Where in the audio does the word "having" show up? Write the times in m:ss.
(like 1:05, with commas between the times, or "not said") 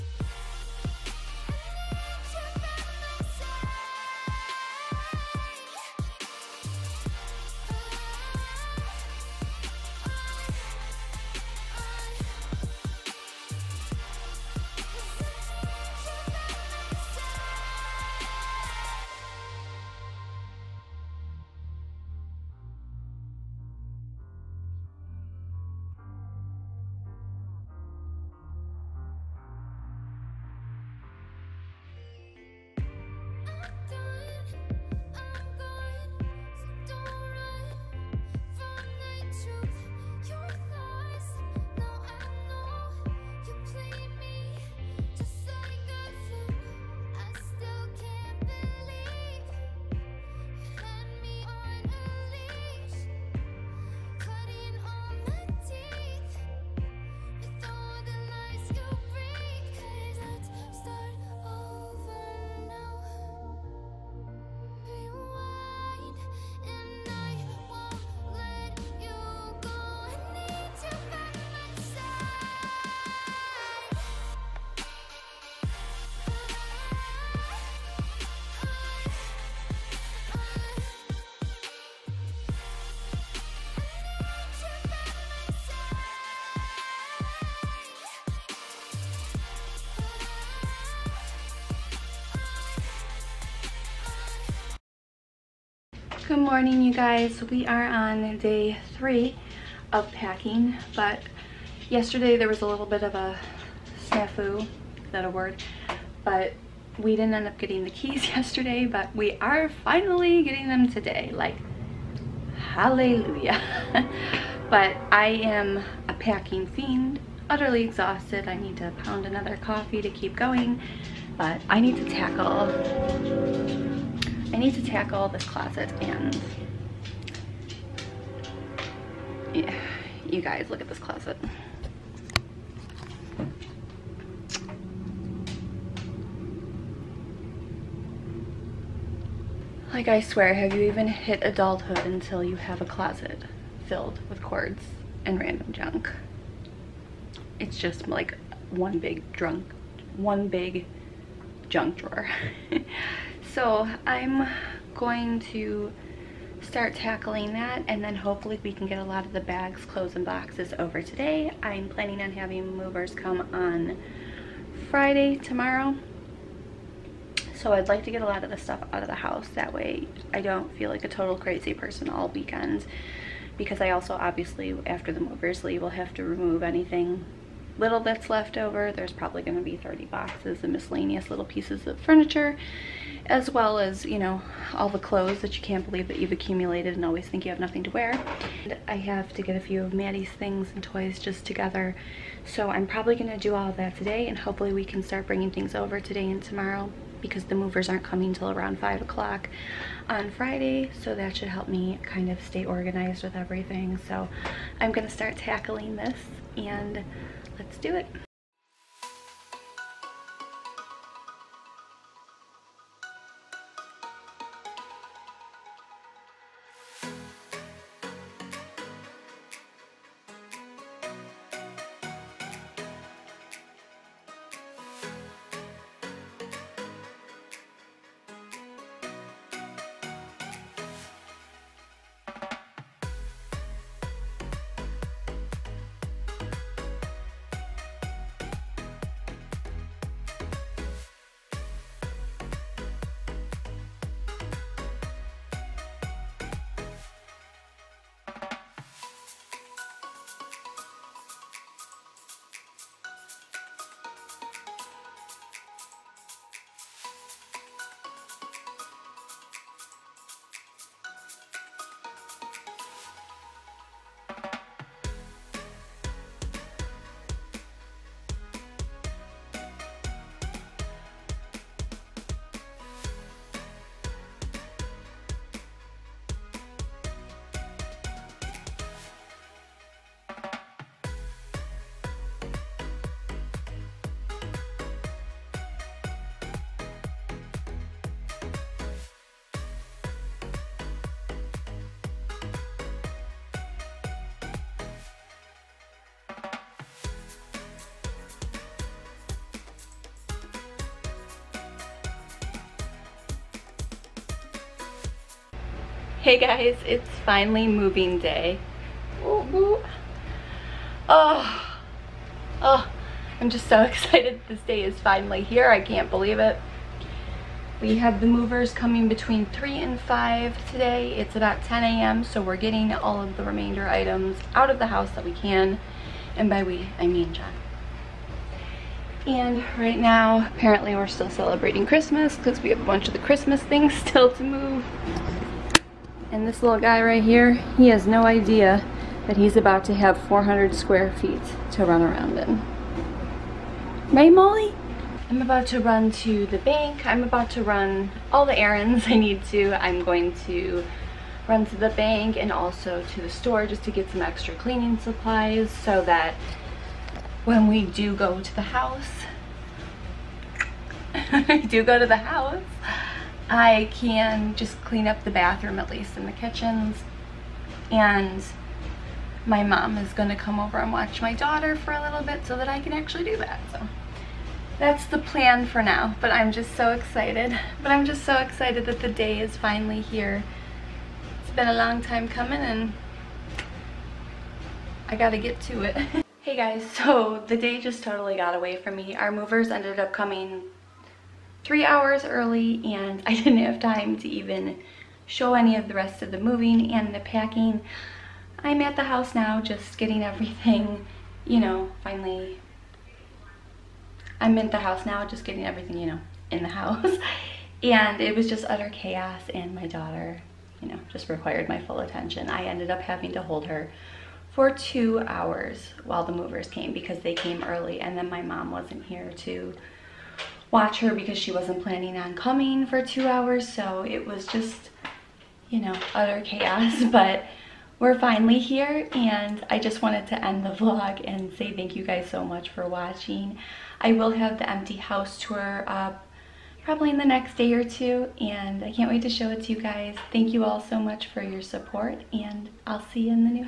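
2:42, 6:52.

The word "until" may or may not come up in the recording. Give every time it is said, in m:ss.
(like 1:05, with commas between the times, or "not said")
2:21.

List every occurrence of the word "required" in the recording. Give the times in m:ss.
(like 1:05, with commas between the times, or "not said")
6:51.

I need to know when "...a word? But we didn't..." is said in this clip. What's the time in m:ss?
1:45.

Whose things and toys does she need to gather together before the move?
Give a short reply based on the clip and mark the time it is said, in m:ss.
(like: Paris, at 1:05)
Maddie, at 3:09.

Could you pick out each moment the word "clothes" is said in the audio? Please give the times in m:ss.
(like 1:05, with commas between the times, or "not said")
2:39, 3:04.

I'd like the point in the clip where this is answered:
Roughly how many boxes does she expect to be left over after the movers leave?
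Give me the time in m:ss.
2:59.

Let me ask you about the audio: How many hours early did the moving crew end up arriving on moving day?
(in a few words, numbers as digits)
3.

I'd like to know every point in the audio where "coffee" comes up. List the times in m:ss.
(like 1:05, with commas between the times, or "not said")
1:59.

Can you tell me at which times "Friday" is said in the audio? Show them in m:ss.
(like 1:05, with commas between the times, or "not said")
2:44, 3:20.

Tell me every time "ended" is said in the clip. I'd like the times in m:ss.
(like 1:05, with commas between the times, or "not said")
6:29, 6:52.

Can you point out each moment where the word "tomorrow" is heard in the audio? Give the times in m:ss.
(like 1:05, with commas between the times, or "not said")
2:45, 3:16.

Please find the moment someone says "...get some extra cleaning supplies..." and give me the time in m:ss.
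5:53.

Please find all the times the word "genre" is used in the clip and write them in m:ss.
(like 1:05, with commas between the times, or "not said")
not said.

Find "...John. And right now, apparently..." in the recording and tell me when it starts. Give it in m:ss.
5:27.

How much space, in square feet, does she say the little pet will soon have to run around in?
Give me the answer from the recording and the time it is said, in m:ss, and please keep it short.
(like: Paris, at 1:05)
400 square feet, at 5:40.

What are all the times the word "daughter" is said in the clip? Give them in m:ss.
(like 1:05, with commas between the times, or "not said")
6:11, 6:49.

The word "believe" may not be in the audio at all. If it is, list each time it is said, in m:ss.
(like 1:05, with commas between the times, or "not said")
3:05, 5:16.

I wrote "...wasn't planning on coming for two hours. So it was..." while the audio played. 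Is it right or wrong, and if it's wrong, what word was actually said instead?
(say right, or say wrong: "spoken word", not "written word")
right.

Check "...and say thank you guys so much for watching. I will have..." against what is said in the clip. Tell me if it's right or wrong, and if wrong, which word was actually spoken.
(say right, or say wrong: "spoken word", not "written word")
right.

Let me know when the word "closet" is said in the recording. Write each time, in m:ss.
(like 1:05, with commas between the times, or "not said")
2:05, 2:10, 2:22.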